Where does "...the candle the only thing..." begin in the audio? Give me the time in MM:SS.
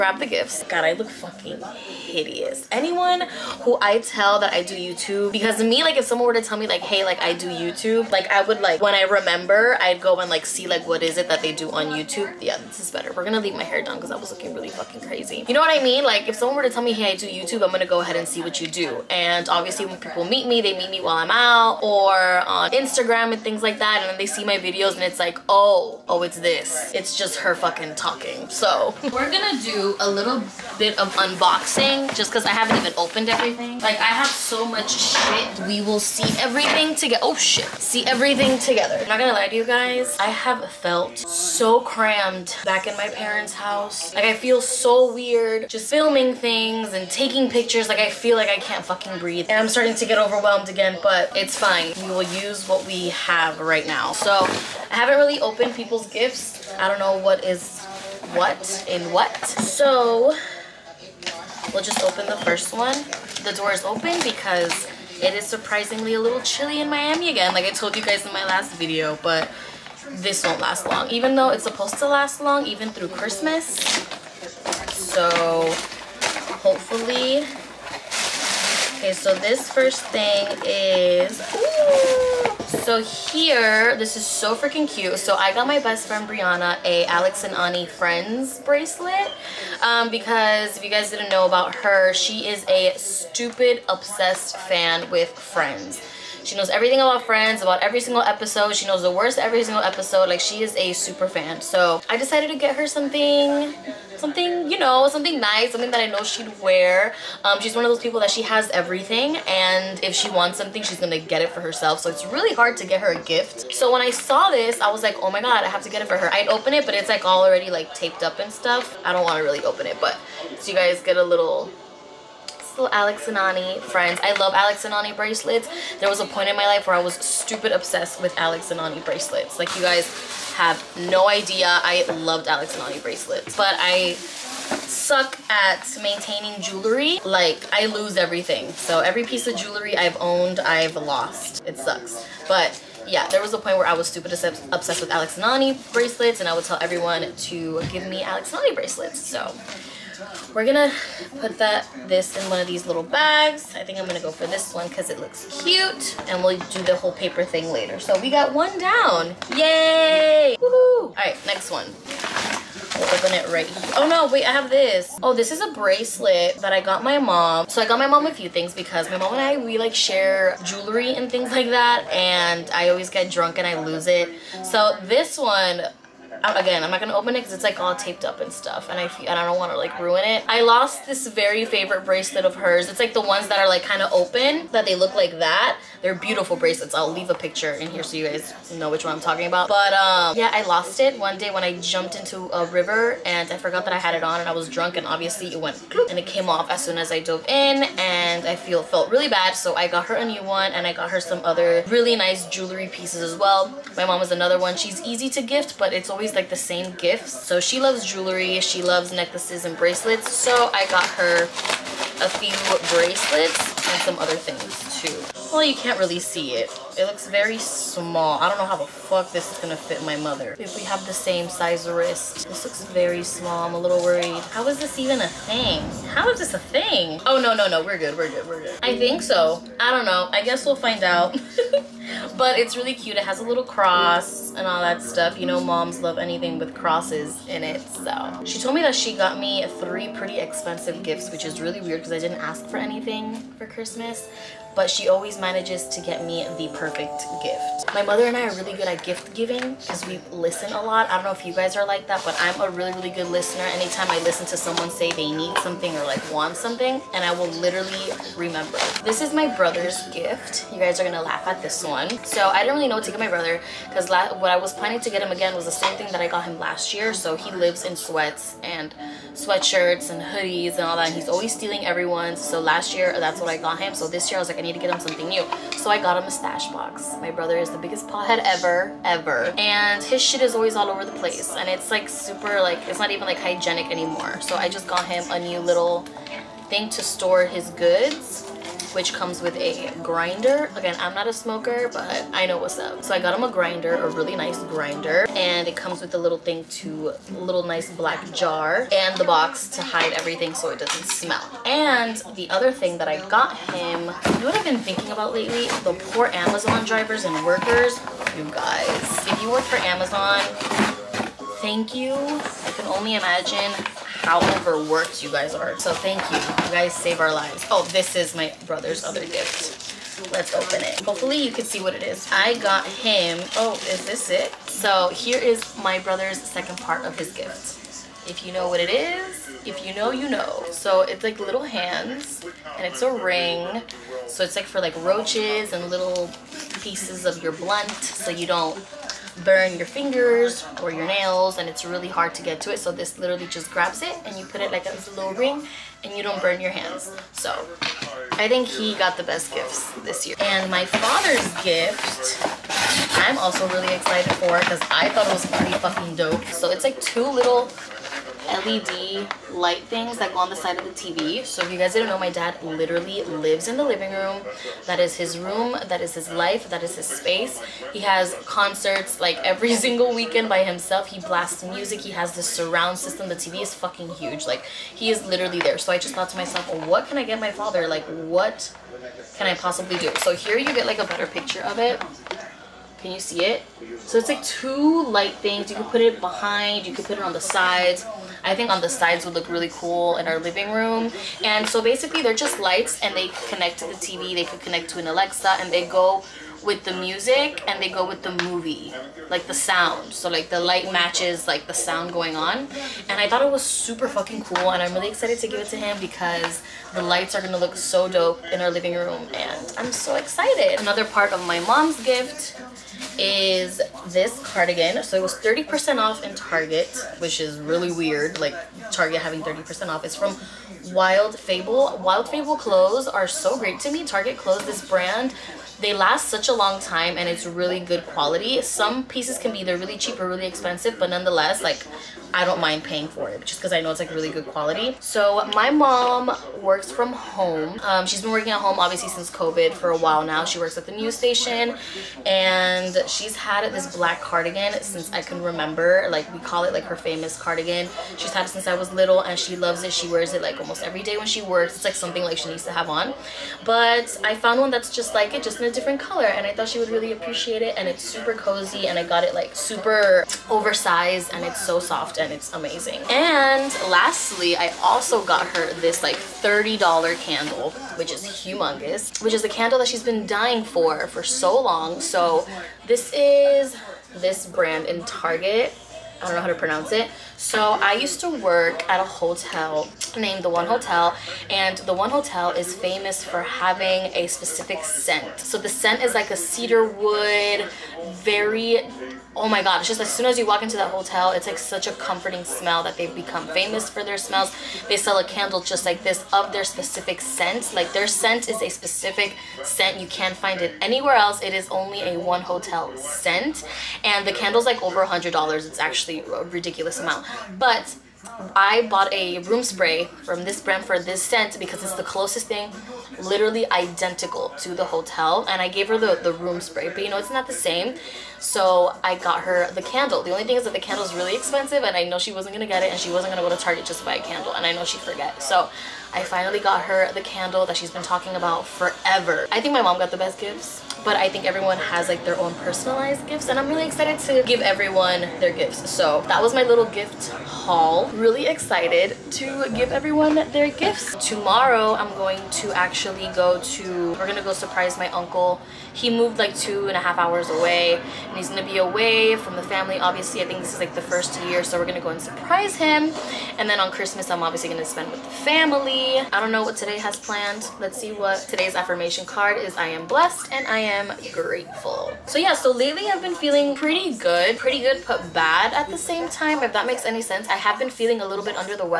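08:39.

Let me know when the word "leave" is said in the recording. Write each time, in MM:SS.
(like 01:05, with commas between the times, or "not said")
00:13, 03:07.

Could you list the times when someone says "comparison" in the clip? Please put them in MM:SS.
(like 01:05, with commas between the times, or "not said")
not said.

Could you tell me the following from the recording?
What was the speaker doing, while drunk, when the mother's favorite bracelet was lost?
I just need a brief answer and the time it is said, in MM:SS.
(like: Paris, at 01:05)
Jumped into a river, at 03:11.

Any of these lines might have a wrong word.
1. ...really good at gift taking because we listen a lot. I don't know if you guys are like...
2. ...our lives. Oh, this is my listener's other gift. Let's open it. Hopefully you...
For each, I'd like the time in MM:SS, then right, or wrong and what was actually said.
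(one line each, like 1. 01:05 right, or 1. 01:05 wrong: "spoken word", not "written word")
1. 04:08 wrong: "giving", not "taking"
2. 05:17 wrong: "brother", not "listener".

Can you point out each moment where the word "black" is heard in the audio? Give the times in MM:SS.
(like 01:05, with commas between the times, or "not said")
04:57, 07:23.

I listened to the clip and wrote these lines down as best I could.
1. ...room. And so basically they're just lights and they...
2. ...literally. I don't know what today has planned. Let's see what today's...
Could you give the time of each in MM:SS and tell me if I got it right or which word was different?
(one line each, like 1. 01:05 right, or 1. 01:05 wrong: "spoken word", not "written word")
1. 06:30 right
2. 09:15 wrong: "family", not "literally".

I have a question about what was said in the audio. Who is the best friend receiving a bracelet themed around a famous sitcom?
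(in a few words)
Brianna.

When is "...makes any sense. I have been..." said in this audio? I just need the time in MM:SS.
09:26.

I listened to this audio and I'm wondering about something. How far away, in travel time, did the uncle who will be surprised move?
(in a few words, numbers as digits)
2.5 hours.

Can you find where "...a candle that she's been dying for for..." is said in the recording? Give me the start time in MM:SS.
07:49.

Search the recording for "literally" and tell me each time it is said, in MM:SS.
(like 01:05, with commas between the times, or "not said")
04:17, 05:43, 06:02, 06:15, 08:33.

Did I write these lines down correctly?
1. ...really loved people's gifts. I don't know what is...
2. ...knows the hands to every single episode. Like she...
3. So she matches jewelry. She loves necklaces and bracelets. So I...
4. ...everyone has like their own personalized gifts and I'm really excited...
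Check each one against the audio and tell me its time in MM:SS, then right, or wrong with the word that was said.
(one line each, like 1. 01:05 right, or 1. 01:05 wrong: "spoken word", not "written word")
1. 00:55 wrong: "opened", not "loved"
2. 01:38 wrong: "words", not "hands"
3. 03:27 wrong: "loves", not "matches"
4. 08:51 right.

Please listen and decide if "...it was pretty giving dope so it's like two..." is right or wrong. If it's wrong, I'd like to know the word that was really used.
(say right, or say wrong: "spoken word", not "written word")
wrong: "fucking", not "giving".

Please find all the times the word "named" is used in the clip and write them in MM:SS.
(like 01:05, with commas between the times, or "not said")
08:00.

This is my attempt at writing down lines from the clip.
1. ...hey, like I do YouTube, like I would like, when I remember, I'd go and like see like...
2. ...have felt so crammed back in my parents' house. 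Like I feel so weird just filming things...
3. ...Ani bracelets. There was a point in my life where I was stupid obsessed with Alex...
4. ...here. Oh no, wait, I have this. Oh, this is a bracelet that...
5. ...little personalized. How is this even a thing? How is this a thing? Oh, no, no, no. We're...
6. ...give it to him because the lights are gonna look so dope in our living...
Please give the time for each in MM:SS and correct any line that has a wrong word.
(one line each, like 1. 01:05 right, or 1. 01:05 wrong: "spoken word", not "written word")
1. 00:06 right
2. 00:40 right
3. 02:04 right
4. 02:43 right
5. 03:43 wrong: "worried", not "personalized"
6. 06:45 right.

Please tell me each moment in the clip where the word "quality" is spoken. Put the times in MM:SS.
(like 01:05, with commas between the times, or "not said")
07:08, 07:14.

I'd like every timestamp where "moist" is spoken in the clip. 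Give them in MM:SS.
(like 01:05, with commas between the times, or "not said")
not said.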